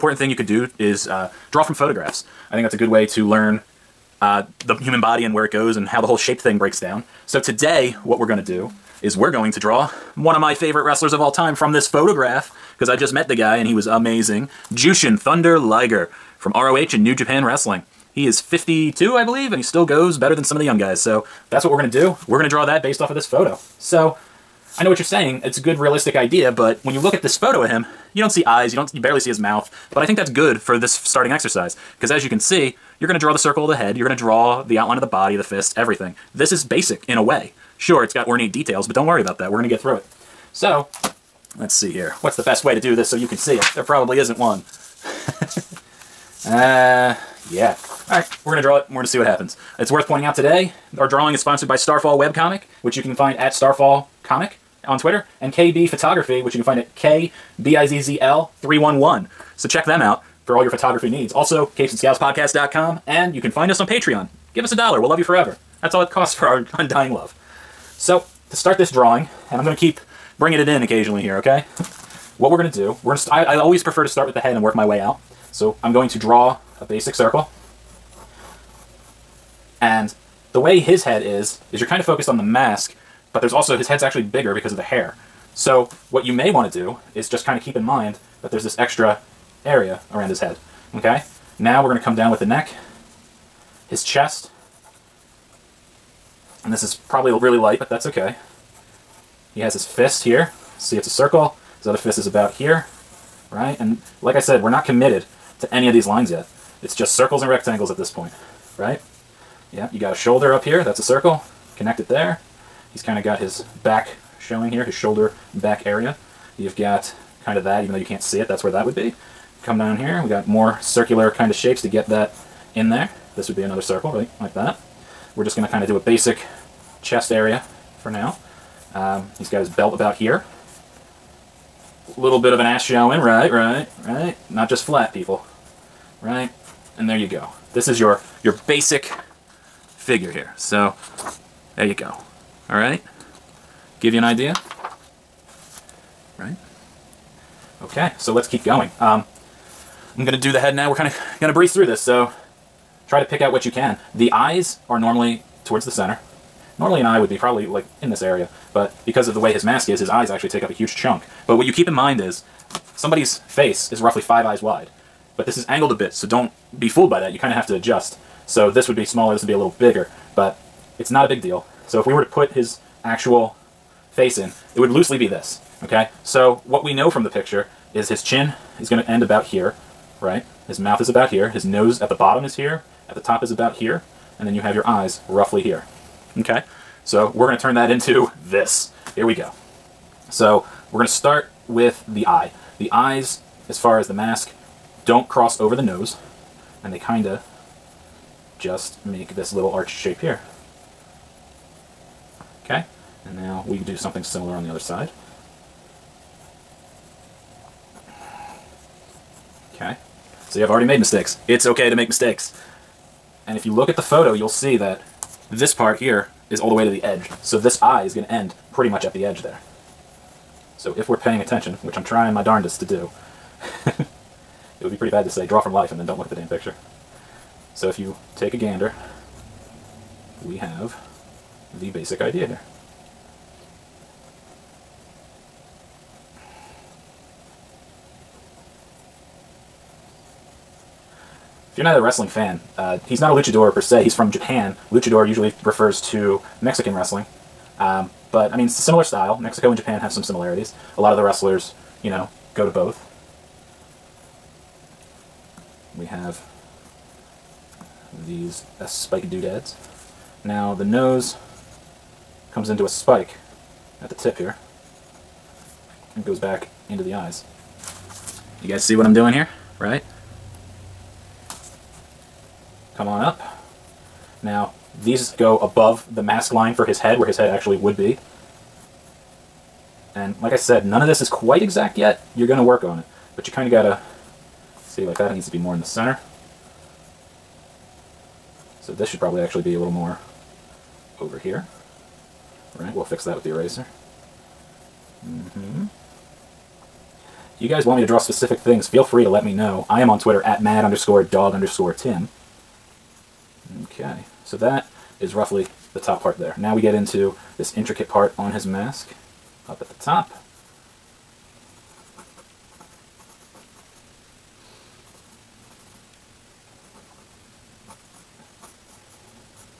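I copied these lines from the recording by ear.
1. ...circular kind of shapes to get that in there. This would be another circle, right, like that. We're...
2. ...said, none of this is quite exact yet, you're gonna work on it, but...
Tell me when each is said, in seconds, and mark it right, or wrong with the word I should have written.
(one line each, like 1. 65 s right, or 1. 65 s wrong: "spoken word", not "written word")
1. 120 s right
2. 280 s right.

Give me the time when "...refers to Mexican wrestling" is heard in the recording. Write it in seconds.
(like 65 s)
245 s.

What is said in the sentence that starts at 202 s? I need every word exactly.
Okay, and now we do something similar on the other side.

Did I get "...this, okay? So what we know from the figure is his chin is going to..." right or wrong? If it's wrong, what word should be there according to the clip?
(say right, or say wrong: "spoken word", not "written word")
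wrong: "picture", not "figure".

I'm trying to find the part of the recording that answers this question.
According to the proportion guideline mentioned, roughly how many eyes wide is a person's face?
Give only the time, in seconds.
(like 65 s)
164 s.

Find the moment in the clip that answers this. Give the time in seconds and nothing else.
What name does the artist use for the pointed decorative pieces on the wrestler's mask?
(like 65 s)
258 s.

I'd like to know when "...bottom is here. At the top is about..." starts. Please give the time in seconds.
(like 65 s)
182 s.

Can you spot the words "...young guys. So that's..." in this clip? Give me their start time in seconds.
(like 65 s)
20 s.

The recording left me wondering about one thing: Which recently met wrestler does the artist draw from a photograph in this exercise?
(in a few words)
Jushin Thunder Liger.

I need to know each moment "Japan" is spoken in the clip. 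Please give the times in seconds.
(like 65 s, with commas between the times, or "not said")
17 s, 244 s, 249 s.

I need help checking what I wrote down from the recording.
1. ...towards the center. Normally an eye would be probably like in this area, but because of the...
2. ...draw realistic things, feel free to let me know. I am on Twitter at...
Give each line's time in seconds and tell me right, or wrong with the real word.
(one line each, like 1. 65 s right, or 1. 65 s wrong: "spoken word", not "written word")
1. 155 s right
2. 298 s wrong: "specific", not "realistic".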